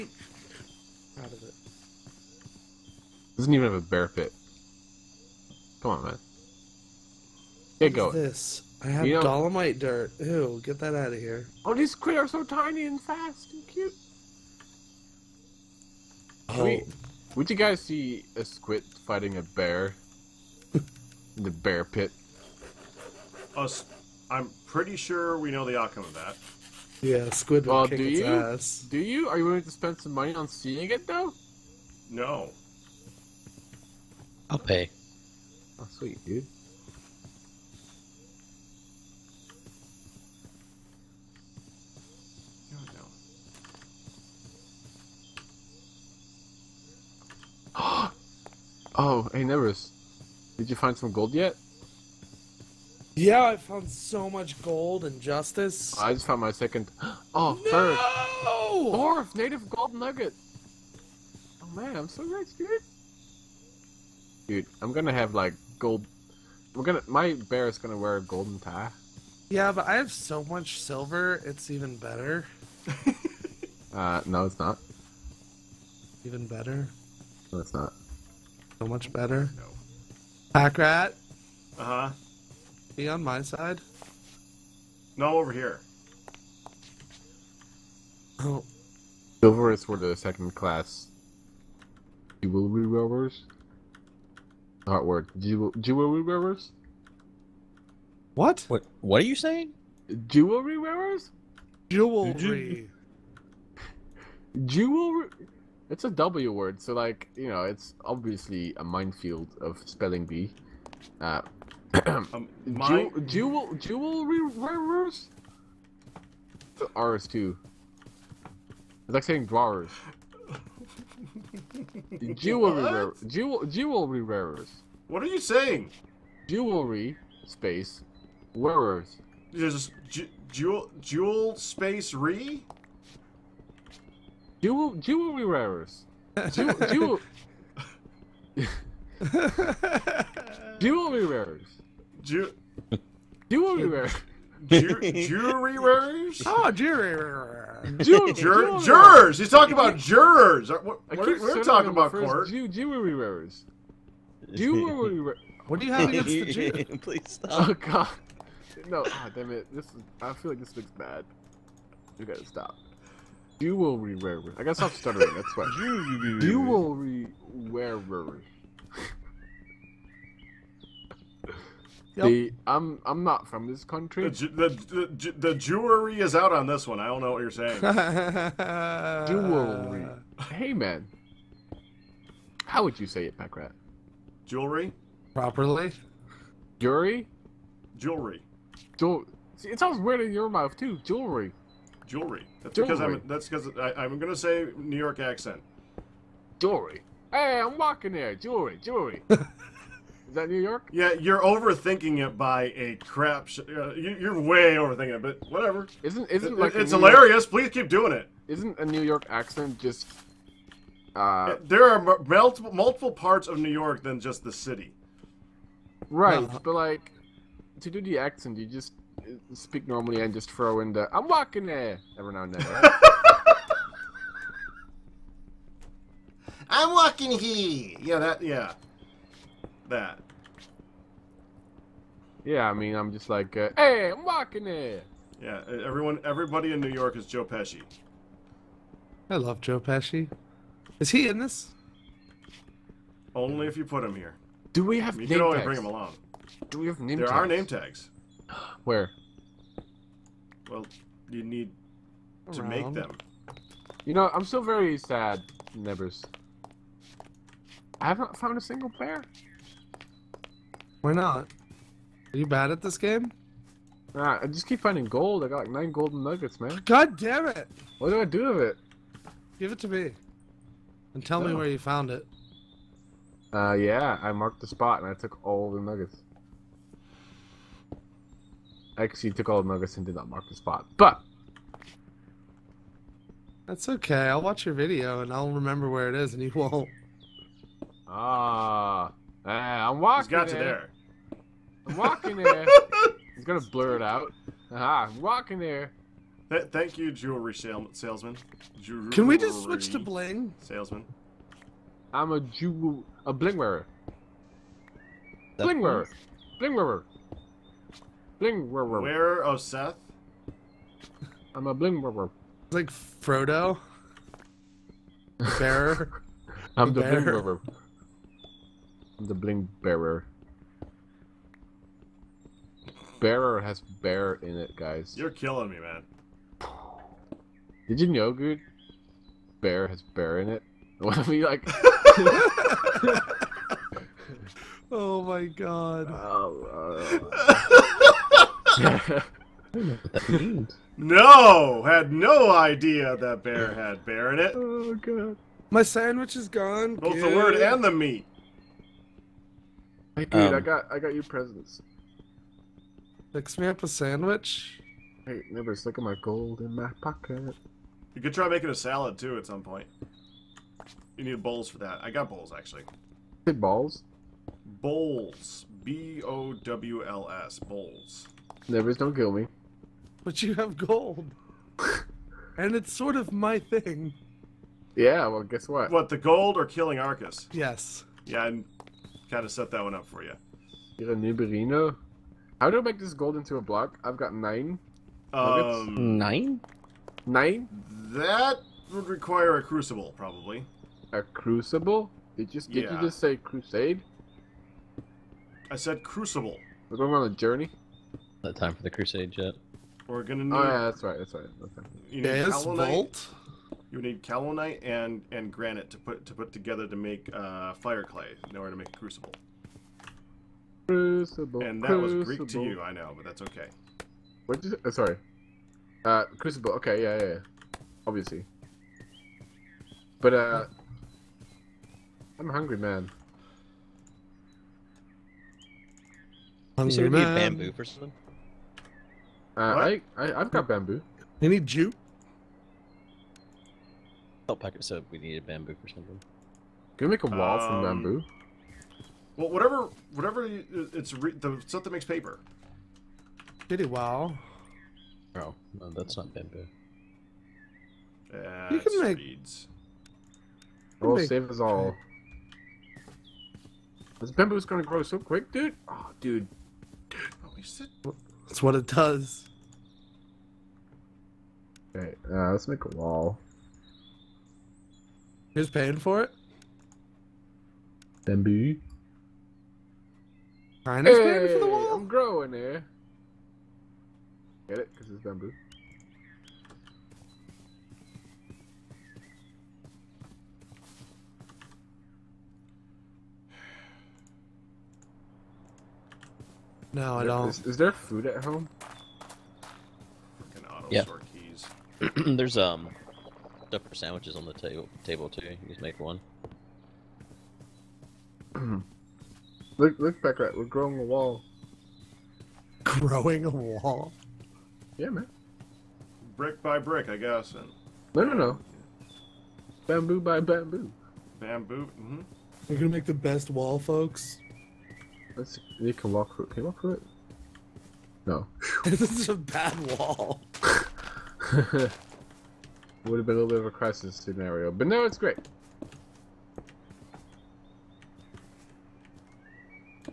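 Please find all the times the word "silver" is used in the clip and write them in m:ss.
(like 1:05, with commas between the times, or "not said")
1:10, 1:29.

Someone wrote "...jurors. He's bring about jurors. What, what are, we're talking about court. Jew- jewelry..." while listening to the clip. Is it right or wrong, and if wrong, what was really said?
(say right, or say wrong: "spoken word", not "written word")
wrong: "talking", not "bring".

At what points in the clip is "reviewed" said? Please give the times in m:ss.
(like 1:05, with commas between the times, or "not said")
not said.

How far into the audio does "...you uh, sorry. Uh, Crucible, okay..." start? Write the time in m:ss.
6:54.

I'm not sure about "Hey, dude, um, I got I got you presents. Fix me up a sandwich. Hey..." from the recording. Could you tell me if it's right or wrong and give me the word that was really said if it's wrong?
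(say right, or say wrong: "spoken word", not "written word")
right.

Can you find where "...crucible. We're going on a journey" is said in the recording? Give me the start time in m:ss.
6:36.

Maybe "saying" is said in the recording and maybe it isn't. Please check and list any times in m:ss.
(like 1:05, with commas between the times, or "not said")
1:39, 1:59, 2:05, 2:57.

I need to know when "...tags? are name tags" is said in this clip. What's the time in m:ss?
4:07.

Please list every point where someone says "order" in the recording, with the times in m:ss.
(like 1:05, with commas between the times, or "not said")
6:48.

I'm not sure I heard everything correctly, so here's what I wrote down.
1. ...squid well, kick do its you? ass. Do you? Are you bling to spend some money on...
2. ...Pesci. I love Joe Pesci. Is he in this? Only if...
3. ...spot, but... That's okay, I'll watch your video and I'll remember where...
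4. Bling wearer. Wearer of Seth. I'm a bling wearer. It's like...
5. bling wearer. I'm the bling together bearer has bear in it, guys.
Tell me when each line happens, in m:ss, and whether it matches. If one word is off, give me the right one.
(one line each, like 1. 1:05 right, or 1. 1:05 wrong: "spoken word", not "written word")
1. 0:27 wrong: "willing", not "bling"
2. 3:57 right
3. 4:40 right
4. 5:08 right
5. 5:17 wrong: "bearer", not "together".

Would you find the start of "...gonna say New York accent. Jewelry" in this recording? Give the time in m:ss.
3:14.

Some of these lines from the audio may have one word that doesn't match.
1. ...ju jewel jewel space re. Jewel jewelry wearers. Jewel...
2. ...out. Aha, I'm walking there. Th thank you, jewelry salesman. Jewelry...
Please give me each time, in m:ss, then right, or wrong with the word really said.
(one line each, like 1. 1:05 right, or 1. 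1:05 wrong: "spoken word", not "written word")
1. 2:10 right
2. 4:54 right.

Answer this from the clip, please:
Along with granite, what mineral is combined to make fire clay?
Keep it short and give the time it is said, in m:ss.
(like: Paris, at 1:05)
Kaolinite, at 6:44.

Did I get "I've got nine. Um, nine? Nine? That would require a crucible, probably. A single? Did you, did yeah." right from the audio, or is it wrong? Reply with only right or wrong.
wrong.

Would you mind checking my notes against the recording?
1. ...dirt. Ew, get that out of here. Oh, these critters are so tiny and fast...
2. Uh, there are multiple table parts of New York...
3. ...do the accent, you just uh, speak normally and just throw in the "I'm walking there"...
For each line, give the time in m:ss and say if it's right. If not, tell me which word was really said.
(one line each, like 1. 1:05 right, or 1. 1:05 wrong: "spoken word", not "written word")
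1. 0:09 right
2. 3:31 wrong: "multiple", not "table"
3. 3:37 right.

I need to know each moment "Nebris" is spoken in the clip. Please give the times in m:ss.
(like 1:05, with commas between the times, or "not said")
0:49, 4:15, 6:08.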